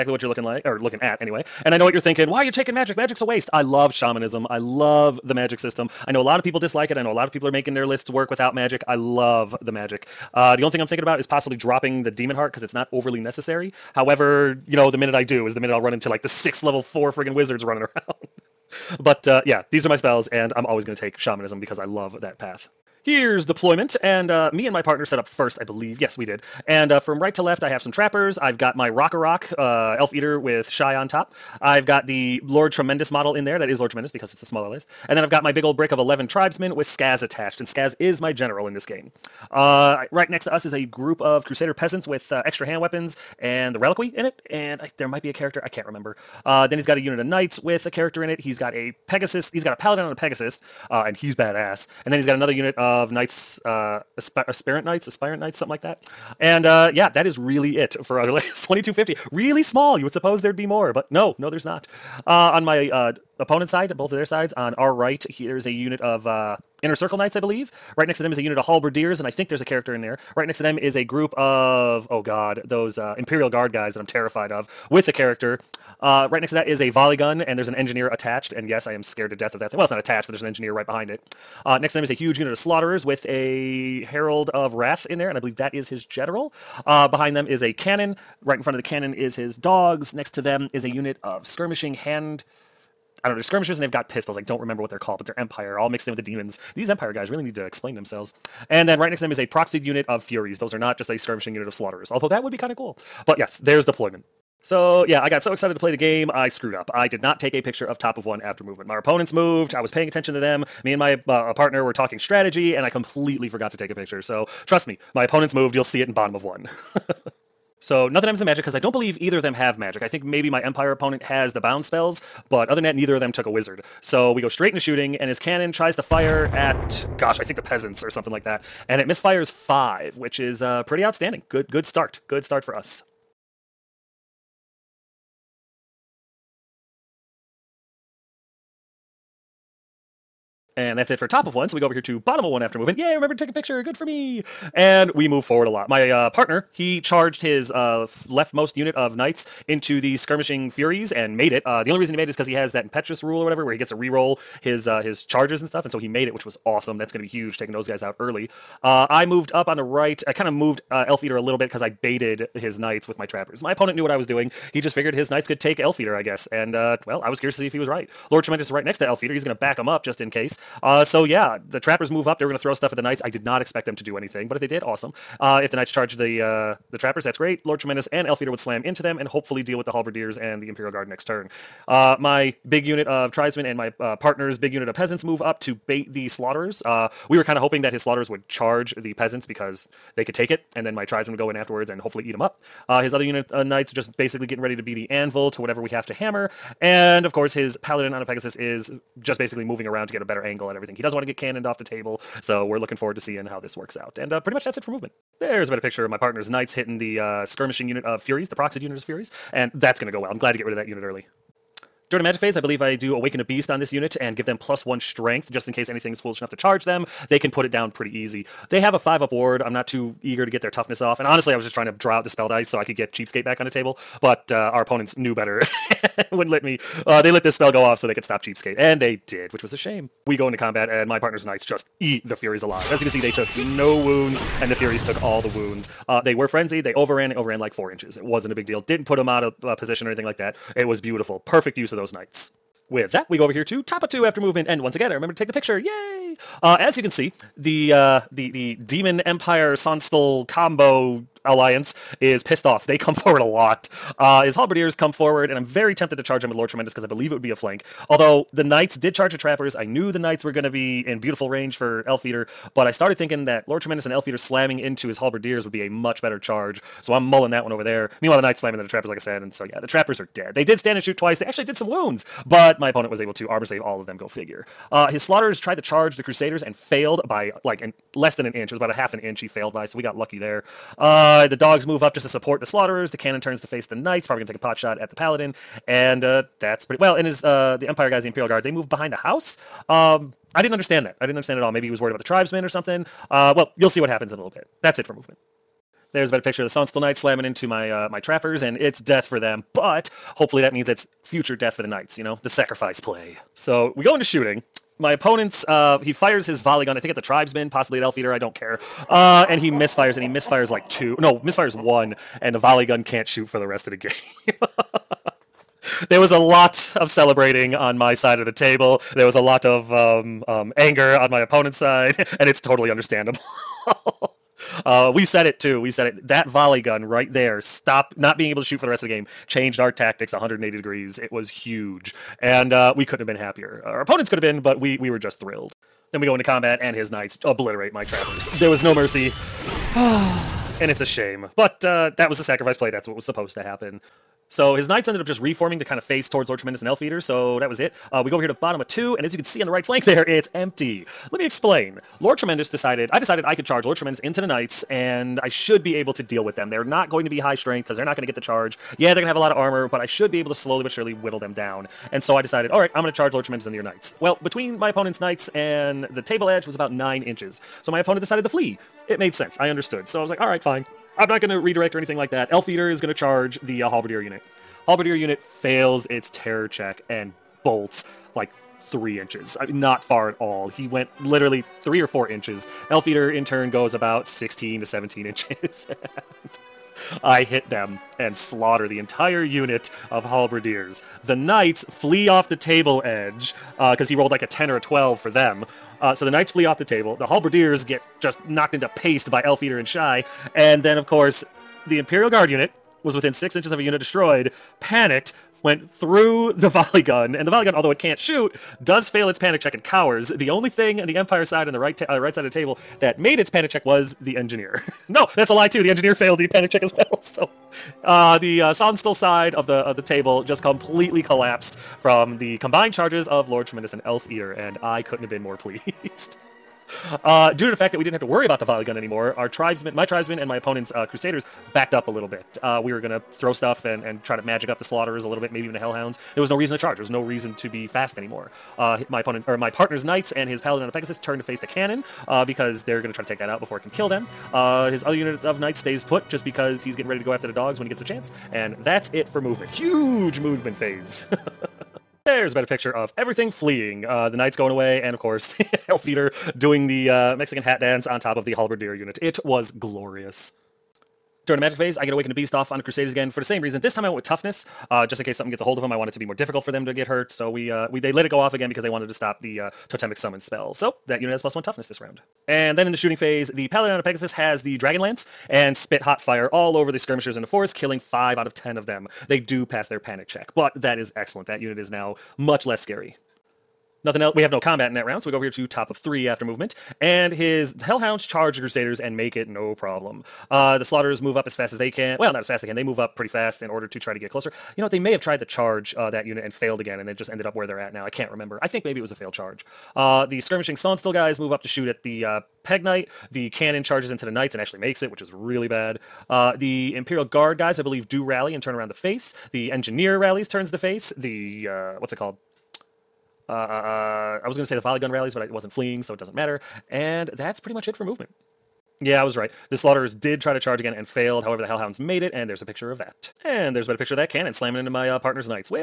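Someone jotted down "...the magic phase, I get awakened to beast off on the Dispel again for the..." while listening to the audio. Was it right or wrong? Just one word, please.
wrong.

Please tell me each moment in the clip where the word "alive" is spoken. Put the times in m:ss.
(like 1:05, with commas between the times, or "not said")
3:52.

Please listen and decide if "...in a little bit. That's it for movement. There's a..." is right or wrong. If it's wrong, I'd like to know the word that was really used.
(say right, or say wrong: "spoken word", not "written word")
right.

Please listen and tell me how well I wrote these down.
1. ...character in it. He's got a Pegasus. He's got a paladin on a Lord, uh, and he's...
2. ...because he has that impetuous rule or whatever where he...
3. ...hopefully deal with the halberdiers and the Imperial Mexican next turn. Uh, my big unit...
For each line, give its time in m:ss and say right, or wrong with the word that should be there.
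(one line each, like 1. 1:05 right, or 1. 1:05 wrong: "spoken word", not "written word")
1. 0:47 wrong: "Pegasus", not "Lord"
2. 2:32 right
3. 2:59 wrong: "Guard", not "Mexican".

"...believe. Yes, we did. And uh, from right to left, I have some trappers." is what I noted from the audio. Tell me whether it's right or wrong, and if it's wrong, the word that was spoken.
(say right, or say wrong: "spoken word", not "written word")
right.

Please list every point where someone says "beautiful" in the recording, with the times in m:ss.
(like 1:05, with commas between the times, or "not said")
4:00, 4:21.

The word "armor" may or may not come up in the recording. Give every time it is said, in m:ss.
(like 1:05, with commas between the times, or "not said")
4:33, 5:59.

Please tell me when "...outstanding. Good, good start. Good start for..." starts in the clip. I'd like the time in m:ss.
2:11.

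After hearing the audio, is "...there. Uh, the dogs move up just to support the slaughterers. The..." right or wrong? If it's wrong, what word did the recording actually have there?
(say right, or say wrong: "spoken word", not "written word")
right.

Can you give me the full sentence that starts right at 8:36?
And that's pretty much it for movement.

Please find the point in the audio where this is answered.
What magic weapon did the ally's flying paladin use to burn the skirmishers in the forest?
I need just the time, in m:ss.
7:54.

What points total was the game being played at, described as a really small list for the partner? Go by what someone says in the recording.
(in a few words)
2250.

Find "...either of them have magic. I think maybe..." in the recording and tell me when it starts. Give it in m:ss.
1:59.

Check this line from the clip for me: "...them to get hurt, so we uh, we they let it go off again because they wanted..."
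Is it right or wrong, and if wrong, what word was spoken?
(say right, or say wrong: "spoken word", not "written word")
right.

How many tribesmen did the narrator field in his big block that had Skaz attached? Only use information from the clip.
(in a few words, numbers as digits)
11.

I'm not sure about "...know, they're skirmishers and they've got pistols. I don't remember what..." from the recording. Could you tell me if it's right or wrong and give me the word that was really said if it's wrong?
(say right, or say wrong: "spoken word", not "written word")
right.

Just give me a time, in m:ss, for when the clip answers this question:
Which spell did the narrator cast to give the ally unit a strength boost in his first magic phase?
3:33.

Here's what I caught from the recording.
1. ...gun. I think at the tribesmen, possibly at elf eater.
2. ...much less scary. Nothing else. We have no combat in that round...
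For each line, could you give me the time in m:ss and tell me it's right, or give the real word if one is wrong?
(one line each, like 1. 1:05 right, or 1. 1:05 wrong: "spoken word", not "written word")
1. 5:06 right
2. 8:02 right.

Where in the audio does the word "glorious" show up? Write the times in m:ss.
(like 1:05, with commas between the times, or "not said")
7:39.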